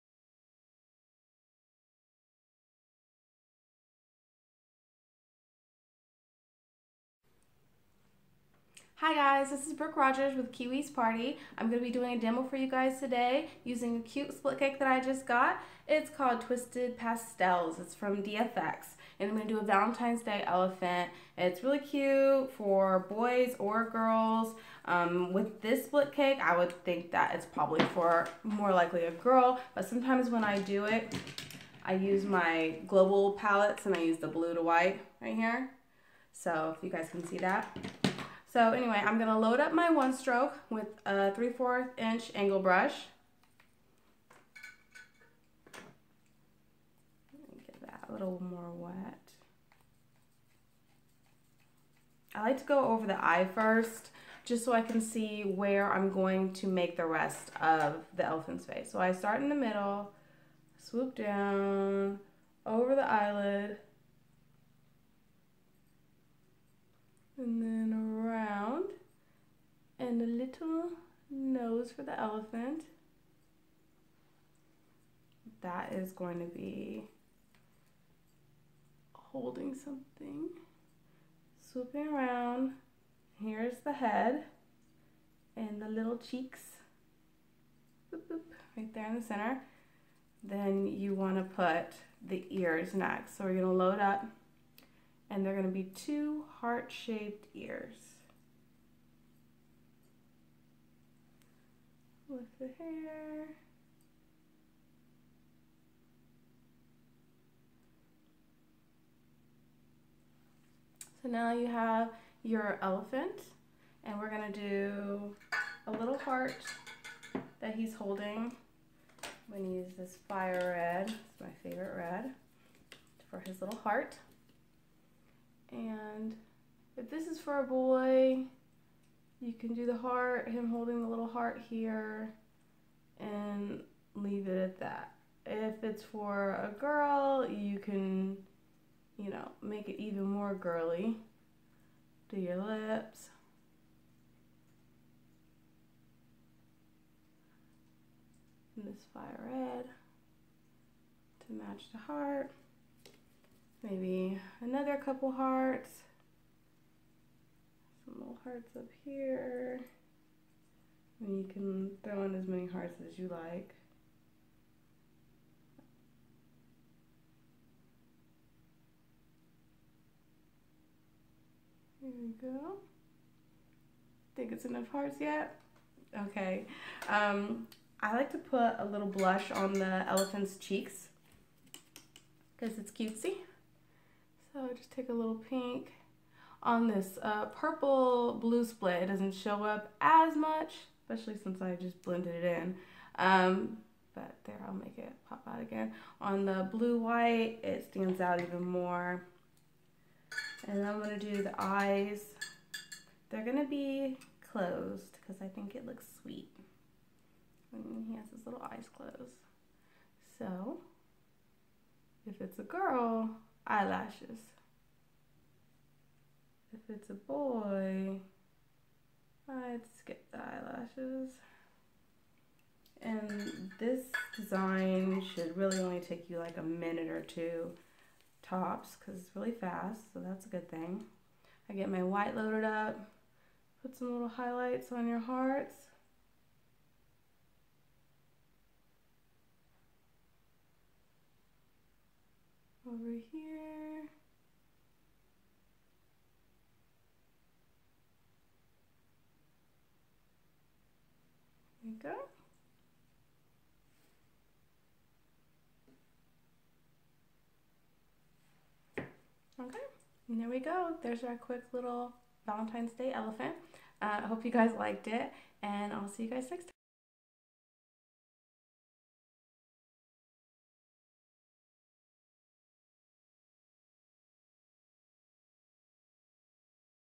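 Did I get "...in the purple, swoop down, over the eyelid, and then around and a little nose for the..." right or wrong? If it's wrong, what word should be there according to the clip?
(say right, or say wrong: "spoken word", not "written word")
wrong: "middle", not "purple".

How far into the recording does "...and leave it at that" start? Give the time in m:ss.
2:13.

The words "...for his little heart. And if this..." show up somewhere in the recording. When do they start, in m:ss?
2:03.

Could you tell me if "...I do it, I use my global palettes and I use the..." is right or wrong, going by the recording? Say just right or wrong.
right.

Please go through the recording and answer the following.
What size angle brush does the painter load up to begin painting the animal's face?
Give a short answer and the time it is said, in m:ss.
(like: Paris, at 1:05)
3/4 inch, at 0:41.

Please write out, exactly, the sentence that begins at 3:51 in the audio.
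I get my white loaded up, put some little highlights on your hearts, over here.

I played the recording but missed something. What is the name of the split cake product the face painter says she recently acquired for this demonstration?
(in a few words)
Twisted Pastels.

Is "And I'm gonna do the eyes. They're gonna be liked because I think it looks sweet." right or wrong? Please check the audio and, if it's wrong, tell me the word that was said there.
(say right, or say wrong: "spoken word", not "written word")
wrong: "closed", not "liked".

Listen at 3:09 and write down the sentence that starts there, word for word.
It doesn't show up as much, especially since I just blended it in.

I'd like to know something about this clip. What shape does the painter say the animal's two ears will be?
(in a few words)
Heart-shaped.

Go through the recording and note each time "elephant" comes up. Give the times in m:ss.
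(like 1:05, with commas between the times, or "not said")
0:20, 0:58, 1:12, 1:52, 3:00, 4:23.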